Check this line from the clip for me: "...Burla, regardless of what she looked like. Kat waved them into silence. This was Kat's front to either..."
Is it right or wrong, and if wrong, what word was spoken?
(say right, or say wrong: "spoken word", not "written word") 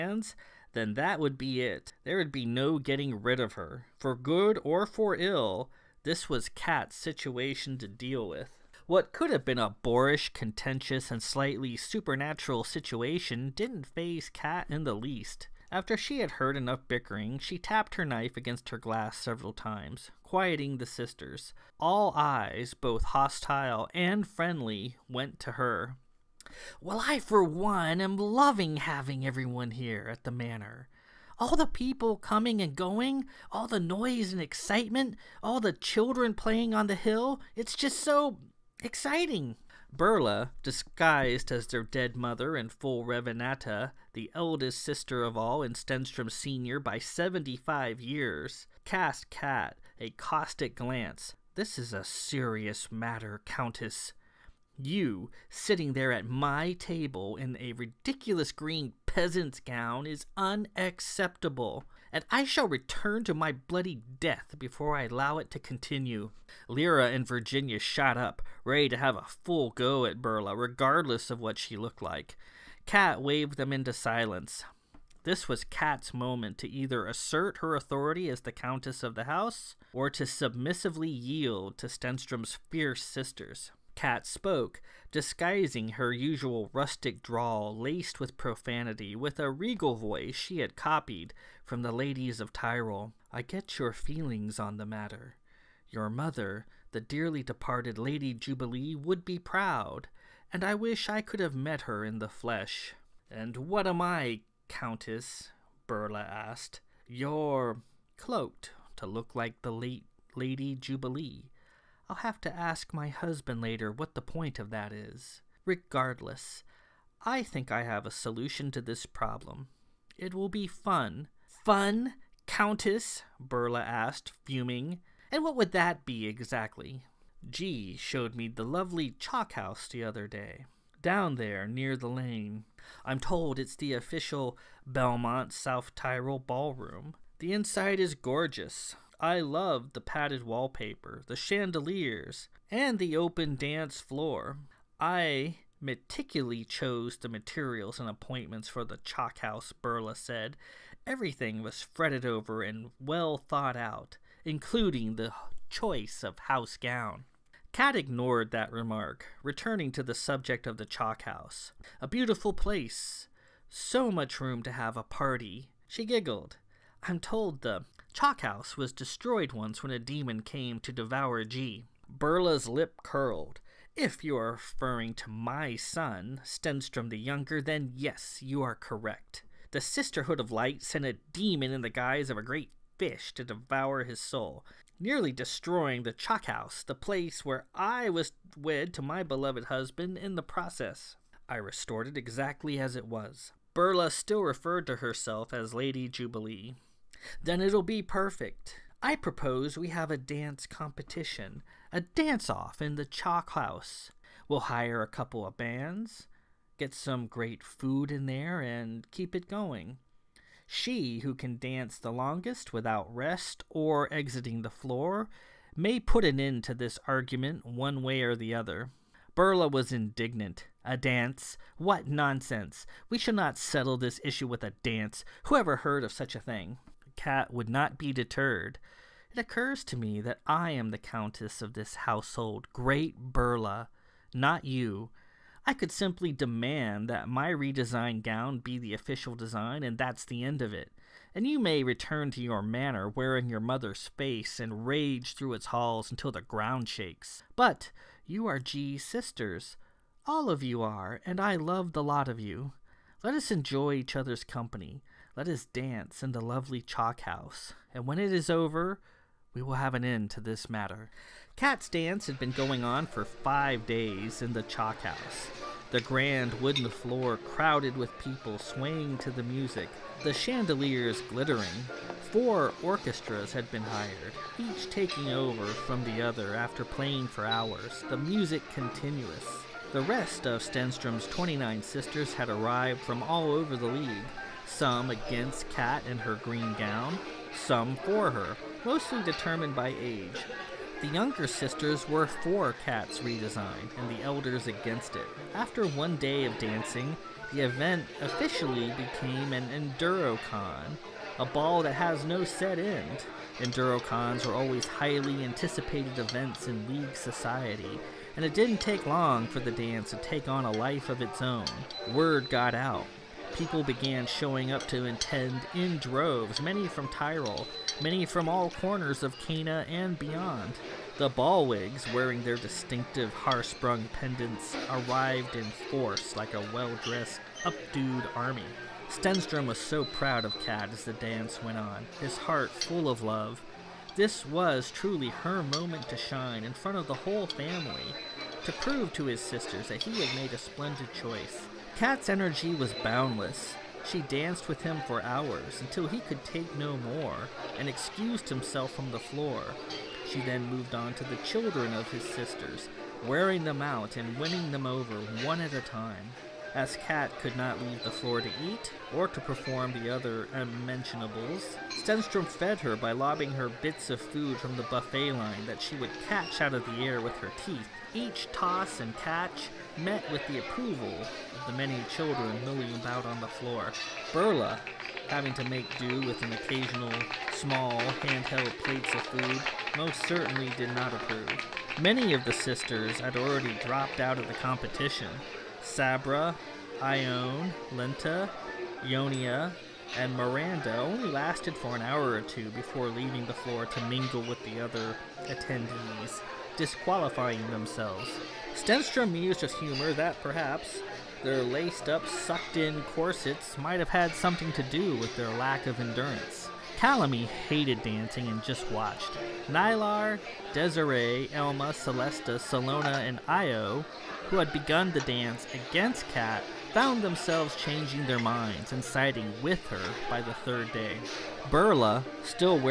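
wrong: "moment", not "front".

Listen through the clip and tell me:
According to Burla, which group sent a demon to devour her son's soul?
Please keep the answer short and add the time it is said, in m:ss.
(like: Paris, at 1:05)
The Sisterhood of Light, at 2:59.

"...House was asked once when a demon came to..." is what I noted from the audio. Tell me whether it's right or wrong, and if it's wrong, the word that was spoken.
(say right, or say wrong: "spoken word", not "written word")
wrong: "destroyed", not "asked".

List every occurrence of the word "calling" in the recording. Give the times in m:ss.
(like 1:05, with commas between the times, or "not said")
not said.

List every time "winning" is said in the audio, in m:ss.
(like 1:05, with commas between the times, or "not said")
5:54.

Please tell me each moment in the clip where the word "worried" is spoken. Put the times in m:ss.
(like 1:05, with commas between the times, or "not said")
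not said.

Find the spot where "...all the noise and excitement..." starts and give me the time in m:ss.
0:33.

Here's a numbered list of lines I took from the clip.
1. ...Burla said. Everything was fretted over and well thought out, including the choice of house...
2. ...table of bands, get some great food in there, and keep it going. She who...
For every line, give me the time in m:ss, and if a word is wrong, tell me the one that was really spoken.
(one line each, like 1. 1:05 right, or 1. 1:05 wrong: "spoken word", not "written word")
1. 2:29 right
2. 3:25 wrong: "couple", not "table".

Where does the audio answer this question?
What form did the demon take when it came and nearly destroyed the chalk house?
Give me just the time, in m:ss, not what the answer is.
3:02.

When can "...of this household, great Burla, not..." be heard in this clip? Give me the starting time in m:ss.
3:51.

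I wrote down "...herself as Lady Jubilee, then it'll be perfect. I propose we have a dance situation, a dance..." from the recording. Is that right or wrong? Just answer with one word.
wrong.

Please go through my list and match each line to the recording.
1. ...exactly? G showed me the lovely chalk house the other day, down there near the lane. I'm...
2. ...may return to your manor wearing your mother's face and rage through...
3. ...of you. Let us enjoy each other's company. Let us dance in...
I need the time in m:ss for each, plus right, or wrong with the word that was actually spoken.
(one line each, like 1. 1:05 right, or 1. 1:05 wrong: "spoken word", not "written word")
1. 2:06 right
2. 4:01 right
3. 4:12 right.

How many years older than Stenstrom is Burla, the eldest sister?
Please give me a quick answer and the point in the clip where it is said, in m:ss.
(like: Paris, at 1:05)
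75 years, at 0:46.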